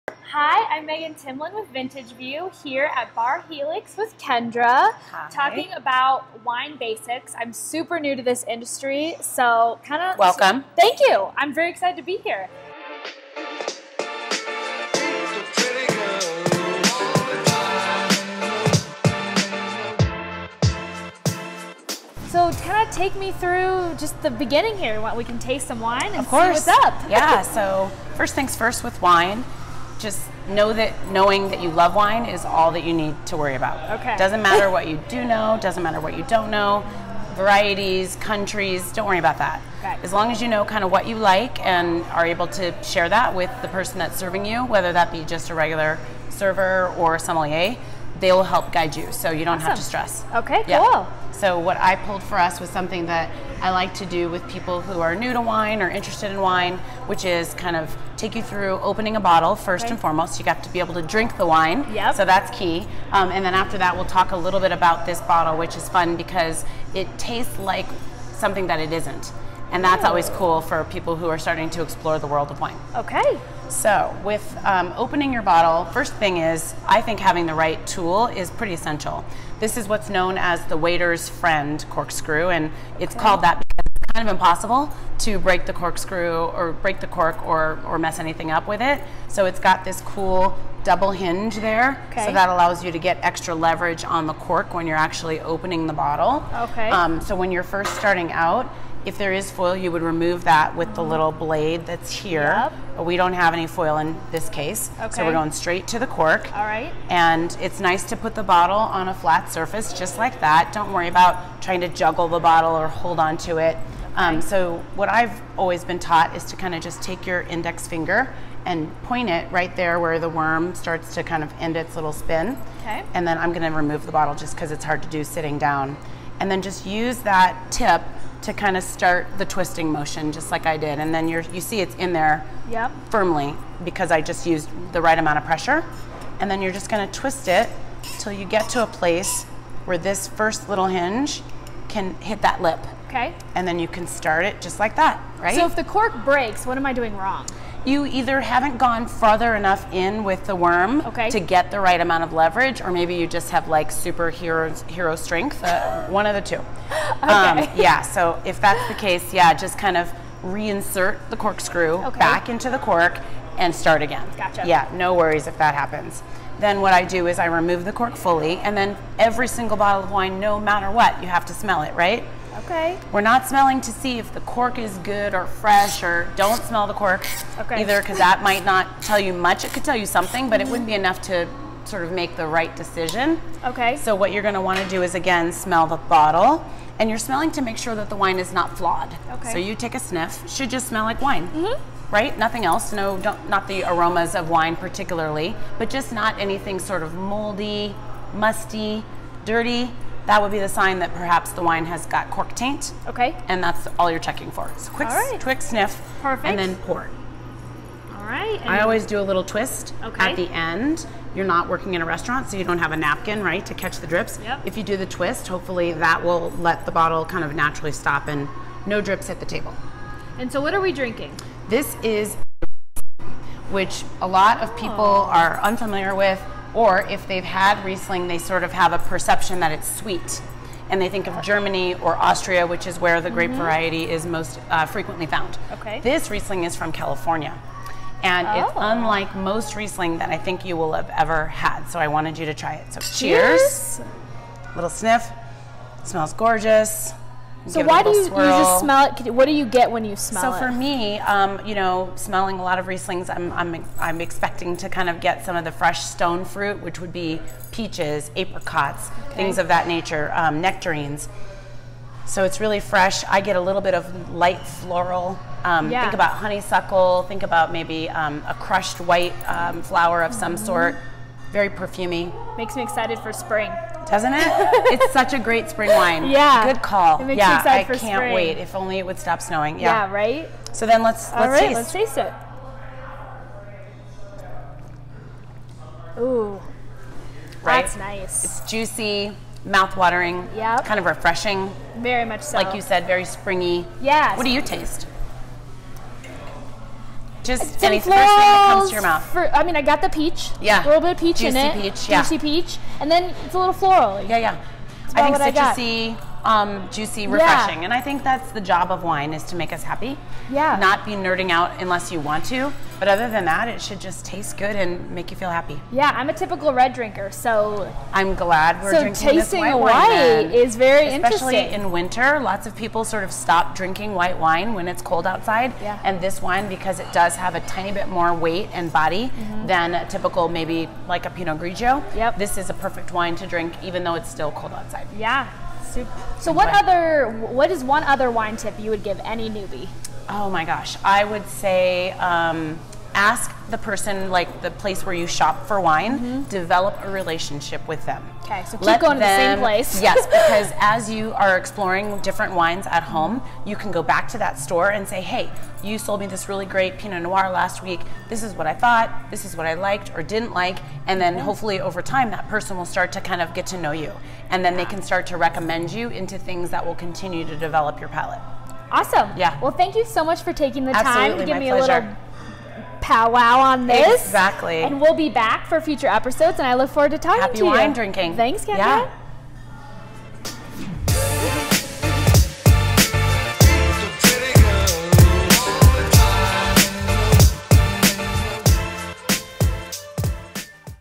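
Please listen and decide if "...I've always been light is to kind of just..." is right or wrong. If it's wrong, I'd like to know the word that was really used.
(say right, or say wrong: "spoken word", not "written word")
wrong: "taught", not "light".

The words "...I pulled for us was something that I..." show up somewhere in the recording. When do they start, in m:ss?
0:51.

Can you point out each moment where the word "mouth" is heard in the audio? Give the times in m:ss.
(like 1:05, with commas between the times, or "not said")
4:49, 4:59.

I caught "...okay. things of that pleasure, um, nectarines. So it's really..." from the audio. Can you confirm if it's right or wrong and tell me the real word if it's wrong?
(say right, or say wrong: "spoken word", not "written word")
wrong: "nature", not "pleasure".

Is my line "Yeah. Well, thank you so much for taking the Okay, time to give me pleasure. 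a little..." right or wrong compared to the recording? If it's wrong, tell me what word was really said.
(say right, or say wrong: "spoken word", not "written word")
wrong: "Absolutely", not "Okay".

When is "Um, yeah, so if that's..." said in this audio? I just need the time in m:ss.
2:37.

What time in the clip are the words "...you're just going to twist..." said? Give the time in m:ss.
2:16.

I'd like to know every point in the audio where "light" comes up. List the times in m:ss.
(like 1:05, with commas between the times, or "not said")
4:24.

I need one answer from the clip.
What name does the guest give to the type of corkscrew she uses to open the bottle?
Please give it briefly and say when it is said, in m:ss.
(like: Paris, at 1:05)
waiter's friend, at 1:20.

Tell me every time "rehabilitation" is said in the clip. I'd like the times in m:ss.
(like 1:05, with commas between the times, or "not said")
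not said.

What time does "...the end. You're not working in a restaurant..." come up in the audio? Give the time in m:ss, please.
3:30.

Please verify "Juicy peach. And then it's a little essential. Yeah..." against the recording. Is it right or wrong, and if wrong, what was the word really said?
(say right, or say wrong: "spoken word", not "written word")
wrong: "floral", not "essential".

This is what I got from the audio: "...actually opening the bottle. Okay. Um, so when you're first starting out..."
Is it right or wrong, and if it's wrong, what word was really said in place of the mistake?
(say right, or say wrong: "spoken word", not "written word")
right.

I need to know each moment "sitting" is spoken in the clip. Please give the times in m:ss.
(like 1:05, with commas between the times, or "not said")
2:05.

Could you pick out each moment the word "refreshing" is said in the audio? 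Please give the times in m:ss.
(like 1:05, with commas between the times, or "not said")
4:51, 5:07.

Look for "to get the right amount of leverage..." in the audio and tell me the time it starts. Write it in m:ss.
2:31.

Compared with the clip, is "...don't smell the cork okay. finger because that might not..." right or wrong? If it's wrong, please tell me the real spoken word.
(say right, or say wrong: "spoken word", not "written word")
wrong: "either", not "finger".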